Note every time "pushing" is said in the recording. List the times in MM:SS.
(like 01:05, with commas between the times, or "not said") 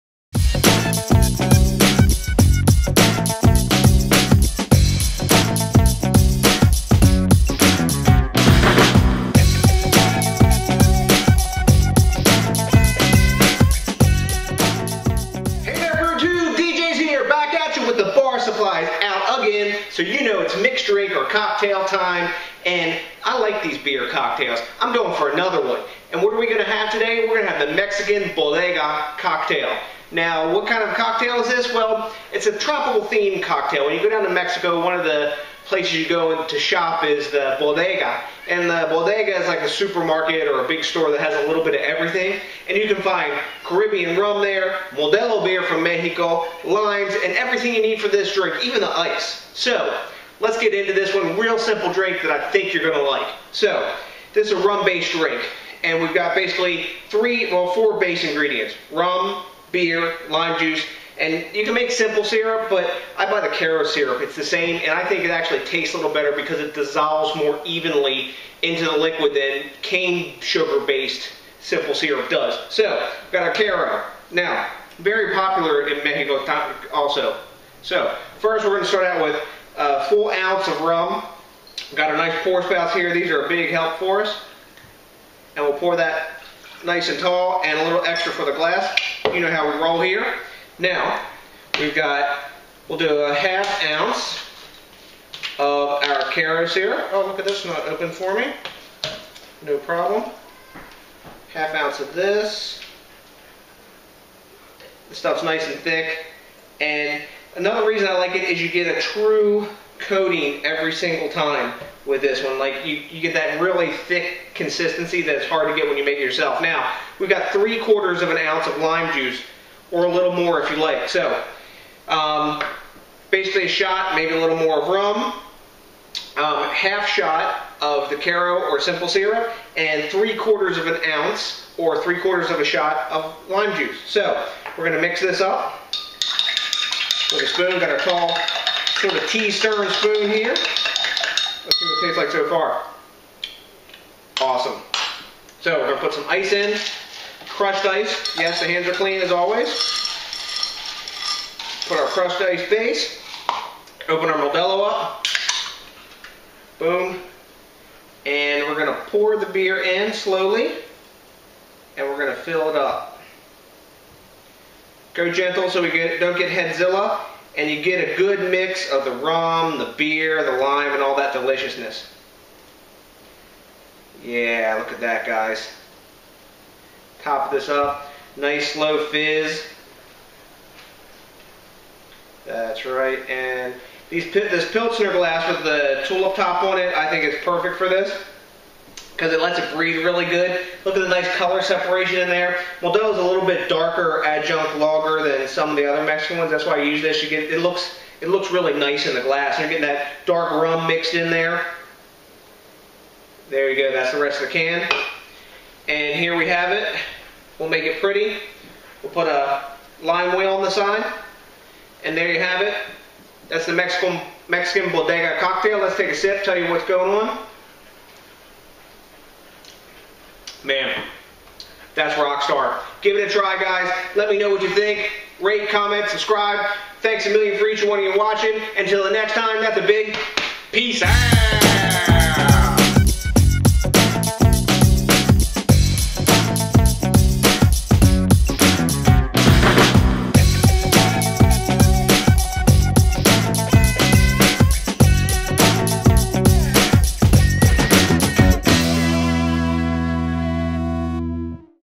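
not said.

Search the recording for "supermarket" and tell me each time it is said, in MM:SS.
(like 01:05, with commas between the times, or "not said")
00:39.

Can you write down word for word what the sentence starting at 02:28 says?
Yes, the hands are clean as always.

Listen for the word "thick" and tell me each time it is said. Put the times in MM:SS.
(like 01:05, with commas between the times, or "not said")
01:45, 01:53.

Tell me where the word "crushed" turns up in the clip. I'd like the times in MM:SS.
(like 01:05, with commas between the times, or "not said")
02:27, 02:32.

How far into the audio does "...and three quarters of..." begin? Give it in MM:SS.
02:09.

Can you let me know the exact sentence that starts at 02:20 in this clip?
Let's see what it tastes like so far.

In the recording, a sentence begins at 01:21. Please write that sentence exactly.
We've got a nice pour spout here.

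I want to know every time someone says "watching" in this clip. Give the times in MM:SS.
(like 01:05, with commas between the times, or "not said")
03:48.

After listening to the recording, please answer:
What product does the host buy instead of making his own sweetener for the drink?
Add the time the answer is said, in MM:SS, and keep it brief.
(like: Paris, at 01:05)
Karo syrup, at 01:03.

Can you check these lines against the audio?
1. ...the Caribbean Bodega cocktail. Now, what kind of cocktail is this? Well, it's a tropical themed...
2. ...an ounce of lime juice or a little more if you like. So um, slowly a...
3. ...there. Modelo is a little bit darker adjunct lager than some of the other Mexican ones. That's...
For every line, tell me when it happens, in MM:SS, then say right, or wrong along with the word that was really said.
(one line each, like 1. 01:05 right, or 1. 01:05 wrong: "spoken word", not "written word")
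1. 00:27 wrong: "Mexican", not "Caribbean"
2. 01:58 wrong: "basically", not "slowly"
3. 03:12 right.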